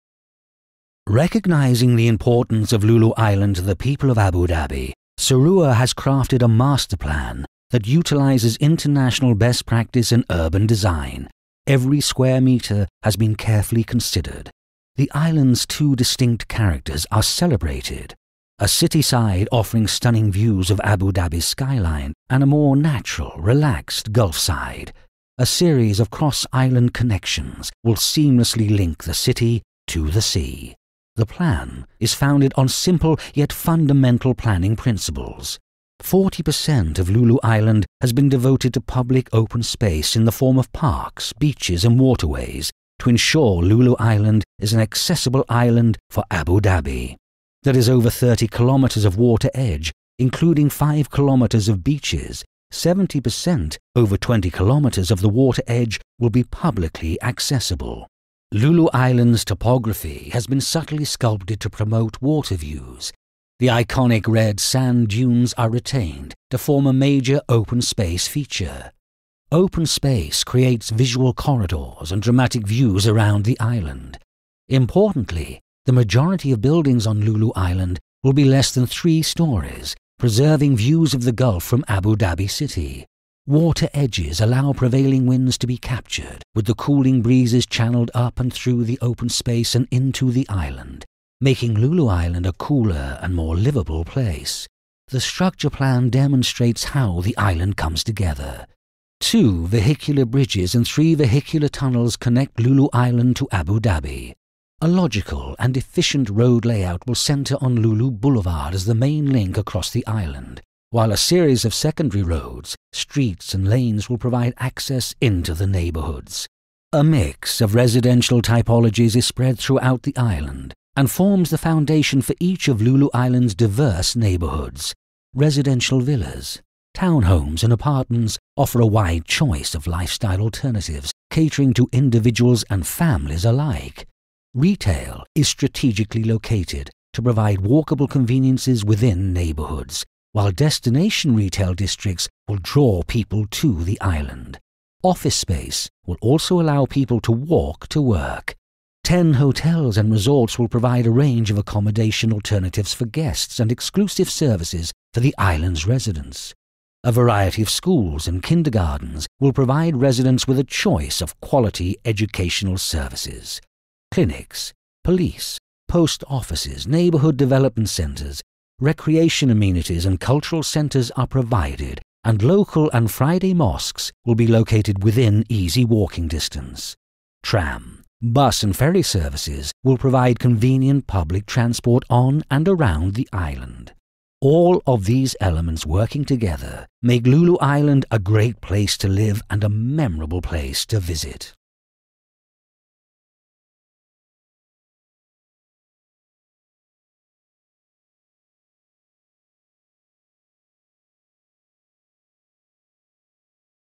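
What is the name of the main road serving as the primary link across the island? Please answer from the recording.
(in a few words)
Lulu Boulevard.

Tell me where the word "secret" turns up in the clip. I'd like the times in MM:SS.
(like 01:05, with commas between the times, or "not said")
not said.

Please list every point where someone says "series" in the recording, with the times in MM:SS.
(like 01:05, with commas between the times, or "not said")
00:25, 01:51.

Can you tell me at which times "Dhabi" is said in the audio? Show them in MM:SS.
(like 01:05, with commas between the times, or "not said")
00:04, 00:21, 00:46, 01:22, 01:43.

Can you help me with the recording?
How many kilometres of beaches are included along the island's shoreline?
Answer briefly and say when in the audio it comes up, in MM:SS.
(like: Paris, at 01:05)
5 kilometres, at 00:50.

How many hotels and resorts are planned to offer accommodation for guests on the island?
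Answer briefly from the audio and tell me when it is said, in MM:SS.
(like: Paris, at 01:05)
10, at 02:29.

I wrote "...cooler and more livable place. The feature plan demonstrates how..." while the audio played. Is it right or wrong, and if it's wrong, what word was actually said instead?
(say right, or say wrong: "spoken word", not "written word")
wrong: "structure", not "feature".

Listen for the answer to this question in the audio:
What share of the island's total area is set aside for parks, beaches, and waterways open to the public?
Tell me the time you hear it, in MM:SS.
00:36.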